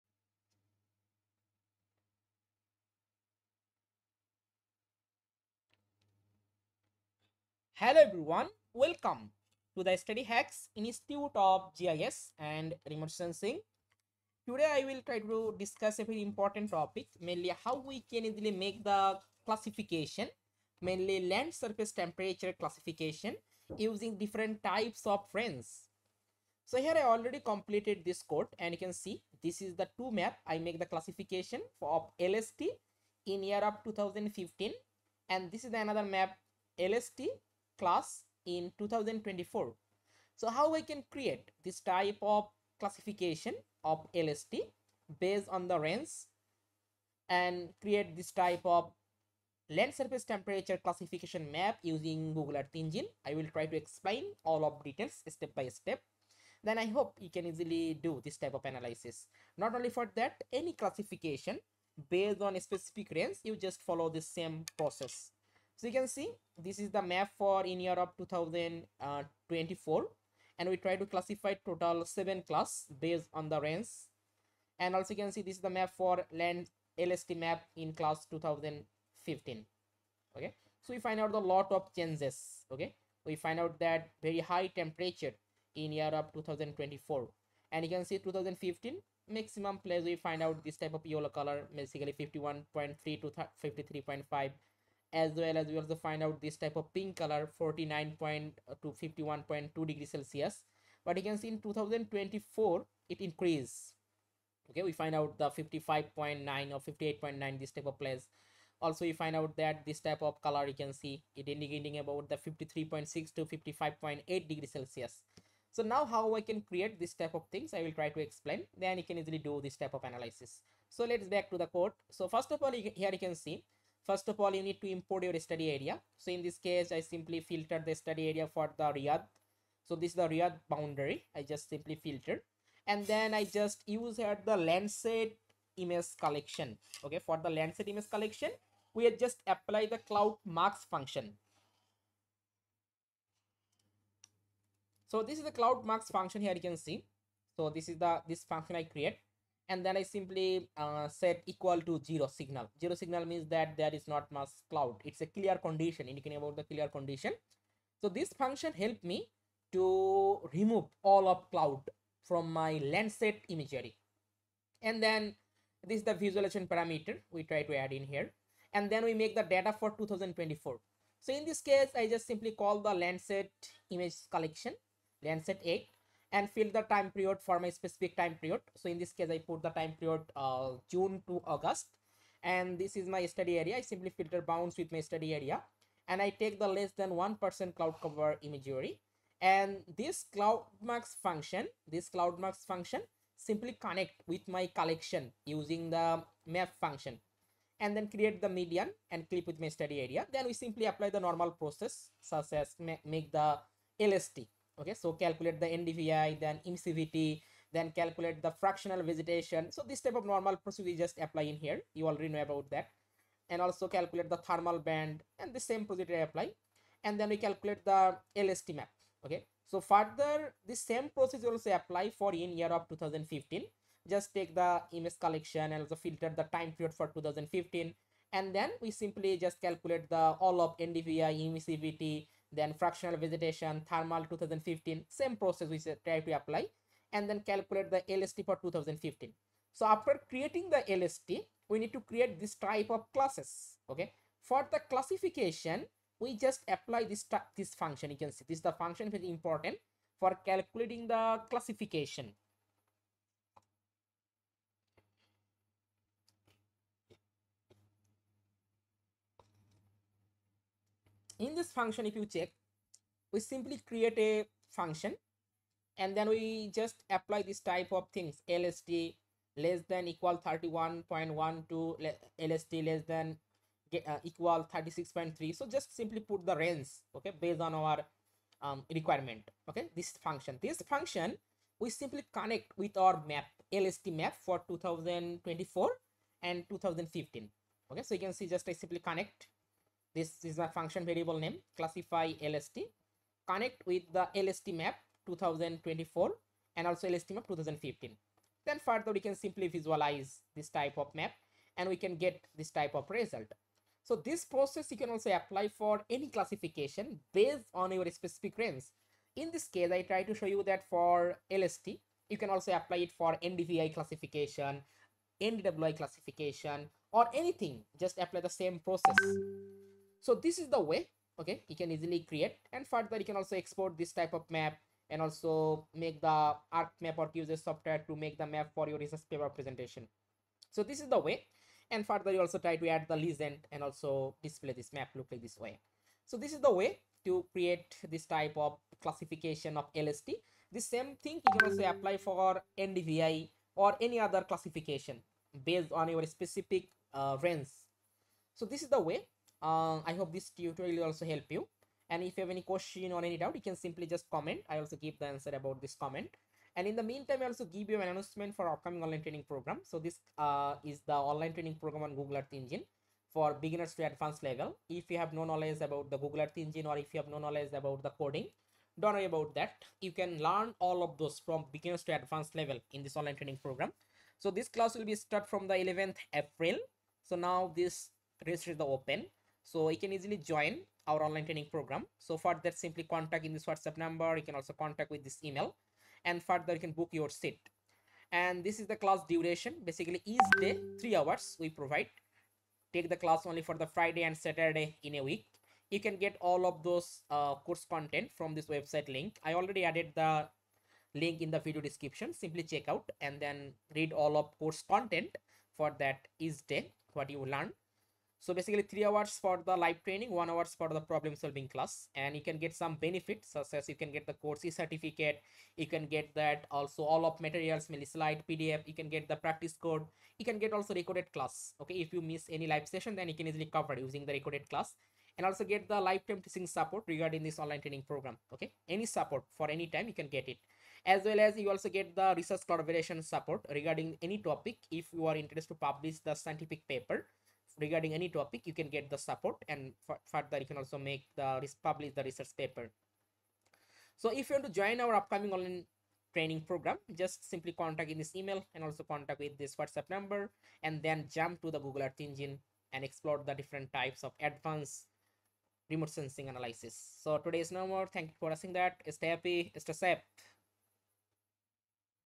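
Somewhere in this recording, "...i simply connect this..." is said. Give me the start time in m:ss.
4:48.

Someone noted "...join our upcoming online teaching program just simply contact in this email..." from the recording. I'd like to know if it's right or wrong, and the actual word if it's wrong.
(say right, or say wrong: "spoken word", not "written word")
wrong: "training", not "teaching".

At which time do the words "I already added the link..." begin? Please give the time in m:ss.
6:39.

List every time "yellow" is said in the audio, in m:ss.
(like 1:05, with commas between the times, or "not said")
1:31.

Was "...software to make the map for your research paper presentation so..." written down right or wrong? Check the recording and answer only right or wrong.
right.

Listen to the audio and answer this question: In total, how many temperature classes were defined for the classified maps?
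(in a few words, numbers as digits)
7.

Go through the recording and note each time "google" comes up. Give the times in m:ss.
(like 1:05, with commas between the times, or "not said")
0:52, 6:02, 6:06, 7:31.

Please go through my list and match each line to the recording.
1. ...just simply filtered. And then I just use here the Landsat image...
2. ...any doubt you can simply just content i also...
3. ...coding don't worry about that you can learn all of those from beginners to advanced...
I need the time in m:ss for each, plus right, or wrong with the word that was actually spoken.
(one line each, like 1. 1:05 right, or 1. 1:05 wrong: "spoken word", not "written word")
1. 2:11 right
2. 5:53 wrong: "comment", not "content"
3. 6:08 right.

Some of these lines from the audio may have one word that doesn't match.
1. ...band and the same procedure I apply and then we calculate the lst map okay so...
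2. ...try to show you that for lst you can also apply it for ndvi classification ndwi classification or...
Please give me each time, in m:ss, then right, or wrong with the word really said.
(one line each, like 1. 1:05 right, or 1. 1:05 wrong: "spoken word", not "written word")
1. 3:34 right
2. 5:10 right.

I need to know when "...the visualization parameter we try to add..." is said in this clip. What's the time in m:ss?
2:46.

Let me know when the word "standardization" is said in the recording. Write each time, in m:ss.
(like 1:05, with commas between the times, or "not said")
not said.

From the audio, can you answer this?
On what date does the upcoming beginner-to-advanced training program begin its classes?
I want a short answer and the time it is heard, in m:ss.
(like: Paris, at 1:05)
11th April, at 6:15.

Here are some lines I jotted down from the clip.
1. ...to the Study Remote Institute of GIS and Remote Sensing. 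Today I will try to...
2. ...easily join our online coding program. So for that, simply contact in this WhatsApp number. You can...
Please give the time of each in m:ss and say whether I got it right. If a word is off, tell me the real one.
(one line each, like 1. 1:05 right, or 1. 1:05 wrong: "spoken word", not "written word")
1. 0:09 wrong: "Hacks", not "Remote"
2. 6:20 wrong: "training", not "coding".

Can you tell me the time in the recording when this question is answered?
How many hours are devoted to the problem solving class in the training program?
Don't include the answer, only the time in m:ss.
6:50.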